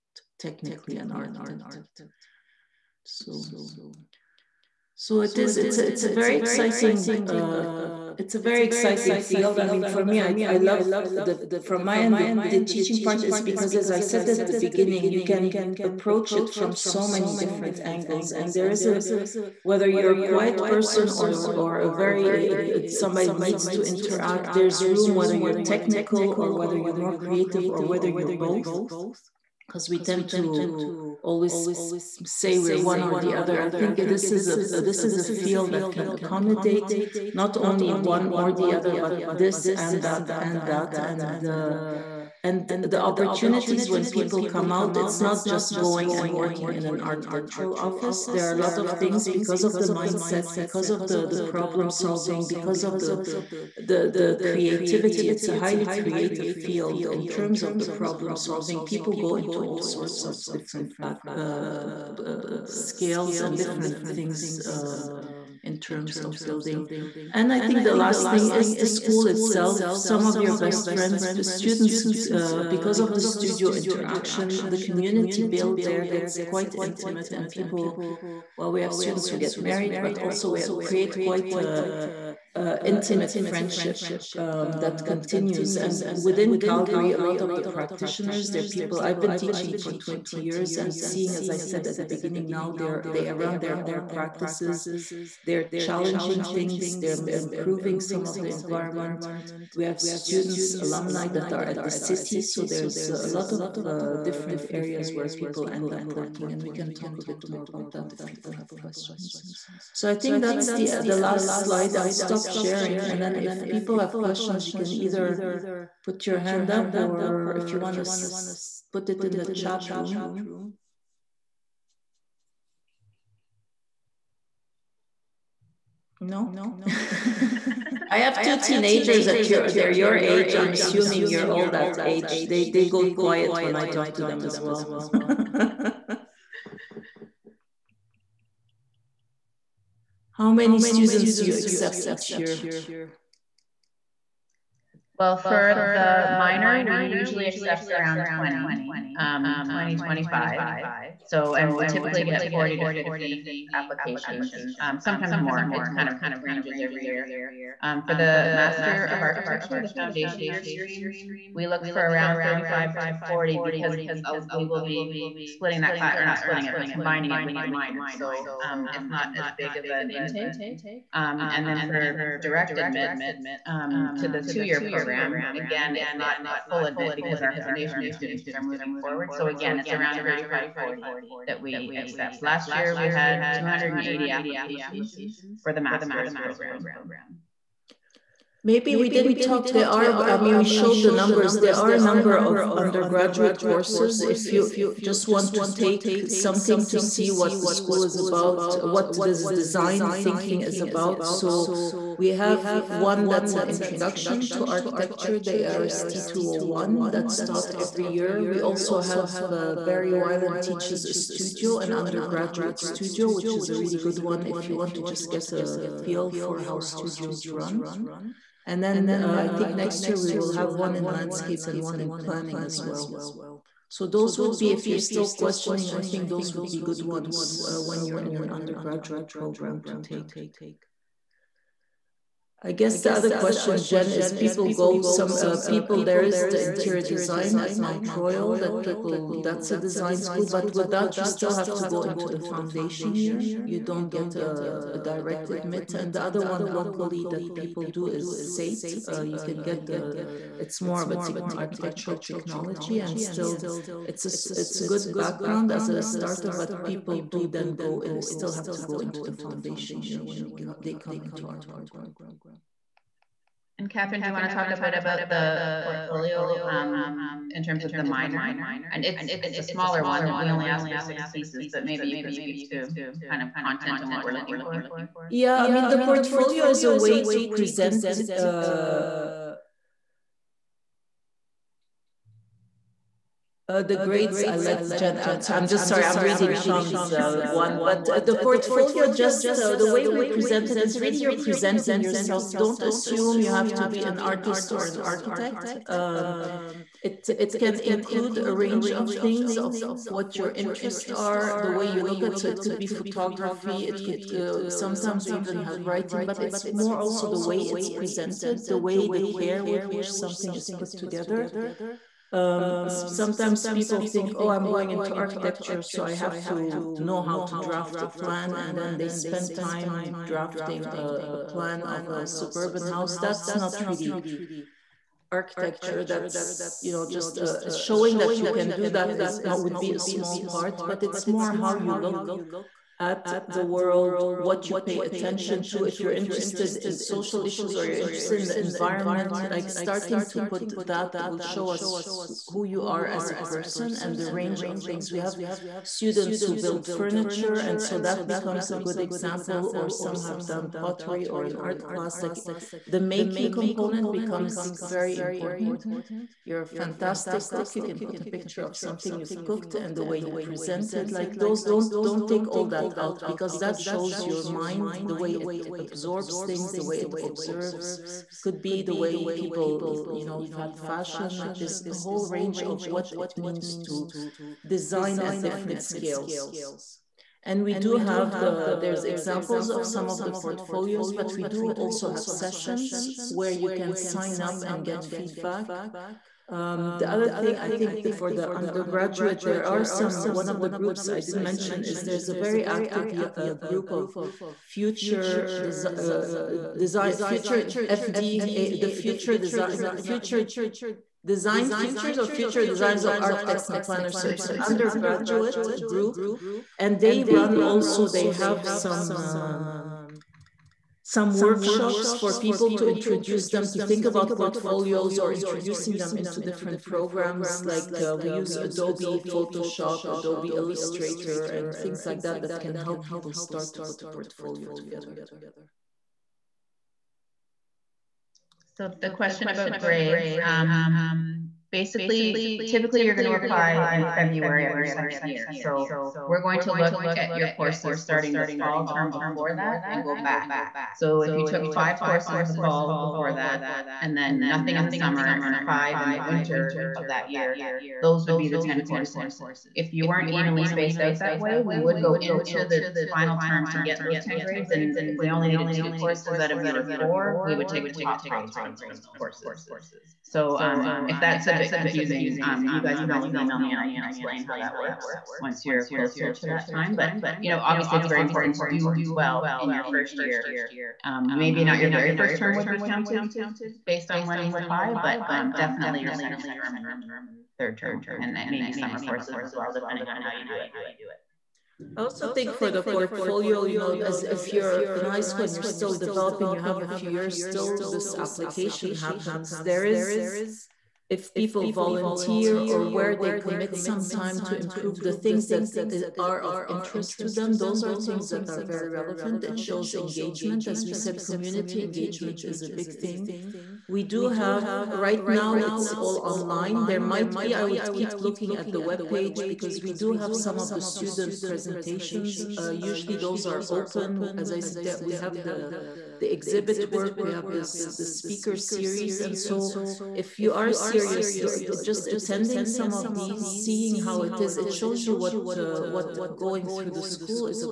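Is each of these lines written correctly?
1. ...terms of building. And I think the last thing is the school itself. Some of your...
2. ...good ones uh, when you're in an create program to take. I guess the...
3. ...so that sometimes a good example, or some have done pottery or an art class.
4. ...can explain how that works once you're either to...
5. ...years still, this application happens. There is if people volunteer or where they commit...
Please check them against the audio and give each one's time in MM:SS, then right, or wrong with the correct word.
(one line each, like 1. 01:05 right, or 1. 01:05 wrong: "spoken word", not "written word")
1. 01:05 right
2. 03:46 wrong: "undergraduate", not "create"
3. 05:47 wrong: "becomes", not "sometimes"
4. 07:43 wrong: "closer", not "either"
5. 08:07 right.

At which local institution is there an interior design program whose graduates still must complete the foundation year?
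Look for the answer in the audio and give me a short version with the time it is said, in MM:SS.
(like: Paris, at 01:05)
Mount Royal, at 03:57.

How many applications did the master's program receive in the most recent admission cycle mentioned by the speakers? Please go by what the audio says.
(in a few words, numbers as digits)
280.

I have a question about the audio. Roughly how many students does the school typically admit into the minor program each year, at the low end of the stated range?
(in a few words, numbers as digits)
20.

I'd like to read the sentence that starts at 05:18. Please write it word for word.
And then they spend time drafting a, a plan of a suburban house.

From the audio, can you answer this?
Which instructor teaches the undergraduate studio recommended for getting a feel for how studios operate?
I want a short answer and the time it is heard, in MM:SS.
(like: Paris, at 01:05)
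Barry Wylant, at 03:29.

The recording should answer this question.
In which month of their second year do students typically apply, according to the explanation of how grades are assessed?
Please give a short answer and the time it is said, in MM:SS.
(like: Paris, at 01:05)
February, at 07:14.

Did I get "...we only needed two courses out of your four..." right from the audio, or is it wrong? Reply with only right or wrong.
right.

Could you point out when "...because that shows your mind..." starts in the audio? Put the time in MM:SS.
06:03.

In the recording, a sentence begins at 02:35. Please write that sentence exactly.
It kind of ranges every year.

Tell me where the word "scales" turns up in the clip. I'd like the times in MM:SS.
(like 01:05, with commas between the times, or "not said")
01:02, 06:15.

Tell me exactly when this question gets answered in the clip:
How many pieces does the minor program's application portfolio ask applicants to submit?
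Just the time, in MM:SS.
04:30.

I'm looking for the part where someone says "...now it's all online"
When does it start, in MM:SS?
08:25.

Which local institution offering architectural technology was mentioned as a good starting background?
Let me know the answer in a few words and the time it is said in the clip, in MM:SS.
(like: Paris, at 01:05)
SAIT, at 04:08.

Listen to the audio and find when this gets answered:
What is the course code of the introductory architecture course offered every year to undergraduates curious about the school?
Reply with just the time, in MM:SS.
03:25.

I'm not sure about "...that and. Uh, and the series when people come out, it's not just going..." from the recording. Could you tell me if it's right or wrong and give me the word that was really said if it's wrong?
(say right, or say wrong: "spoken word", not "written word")
wrong: "opportunities", not "series".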